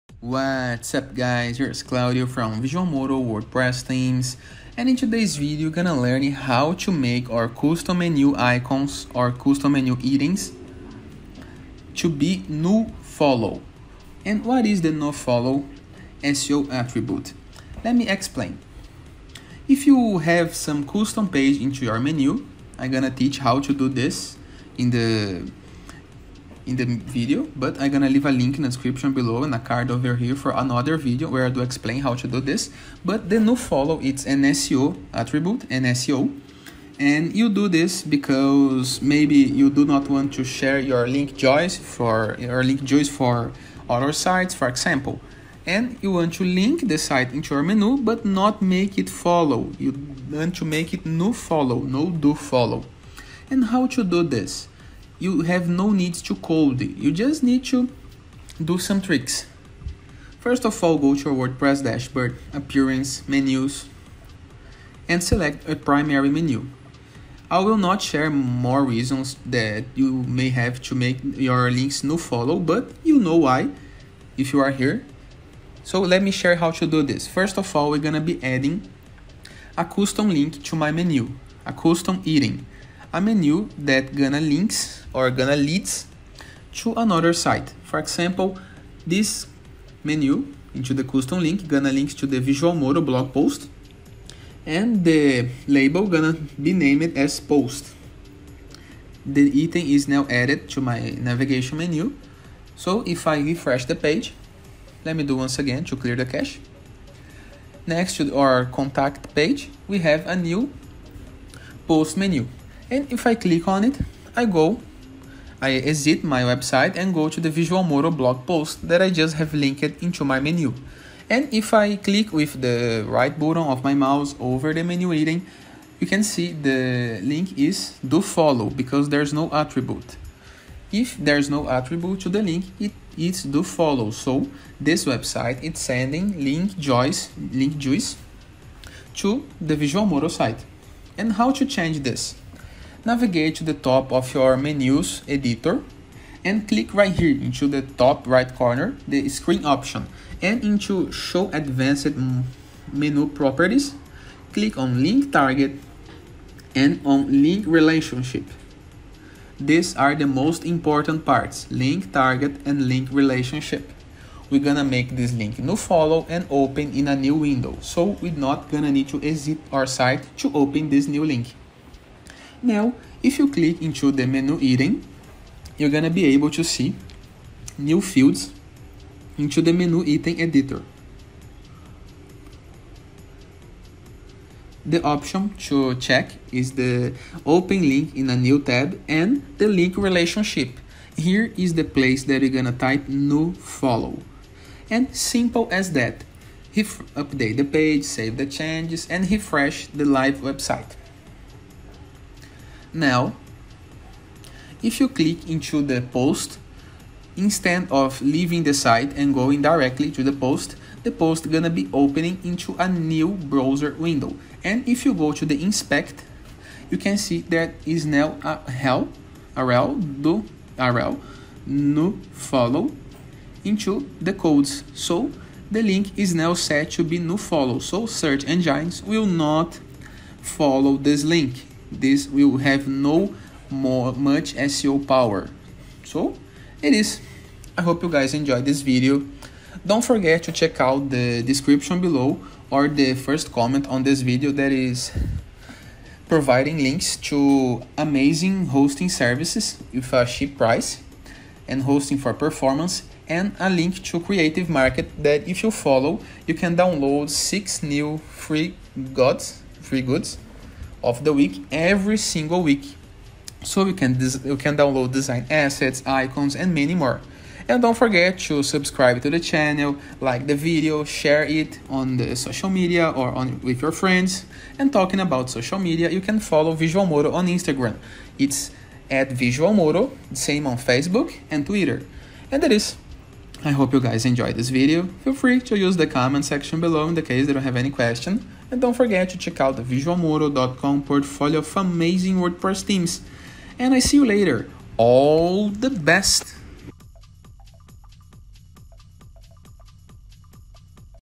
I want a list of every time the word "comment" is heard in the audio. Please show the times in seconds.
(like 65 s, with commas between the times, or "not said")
243 s, 286 s.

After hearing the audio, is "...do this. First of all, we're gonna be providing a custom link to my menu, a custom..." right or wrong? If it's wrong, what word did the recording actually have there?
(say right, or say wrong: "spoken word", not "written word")
wrong: "adding", not "providing".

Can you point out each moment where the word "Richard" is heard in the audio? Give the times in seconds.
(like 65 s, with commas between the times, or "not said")
not said.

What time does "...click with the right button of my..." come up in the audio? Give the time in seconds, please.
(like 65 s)
121 s.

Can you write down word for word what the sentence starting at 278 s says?
It's at Visual Modo, same on Facebook and Twitter.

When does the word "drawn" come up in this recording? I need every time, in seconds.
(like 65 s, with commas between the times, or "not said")
not said.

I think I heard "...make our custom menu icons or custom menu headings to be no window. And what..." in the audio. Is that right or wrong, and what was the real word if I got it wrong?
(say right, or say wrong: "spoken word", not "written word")
wrong: "follow", not "window".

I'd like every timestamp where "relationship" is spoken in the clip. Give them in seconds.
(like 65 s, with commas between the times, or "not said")
157 s, 163 s, 189 s.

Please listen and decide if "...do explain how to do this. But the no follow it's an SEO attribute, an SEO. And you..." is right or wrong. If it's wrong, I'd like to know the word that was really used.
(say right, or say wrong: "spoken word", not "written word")
right.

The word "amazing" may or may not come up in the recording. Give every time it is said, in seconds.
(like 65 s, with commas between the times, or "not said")
247 s, 291 s.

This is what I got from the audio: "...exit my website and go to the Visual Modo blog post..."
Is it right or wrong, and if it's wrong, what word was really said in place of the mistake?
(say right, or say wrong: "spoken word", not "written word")
right.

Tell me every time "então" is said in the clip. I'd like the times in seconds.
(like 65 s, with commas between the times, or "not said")
288 s.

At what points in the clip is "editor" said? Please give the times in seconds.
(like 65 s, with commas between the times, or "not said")
145 s, 180 s.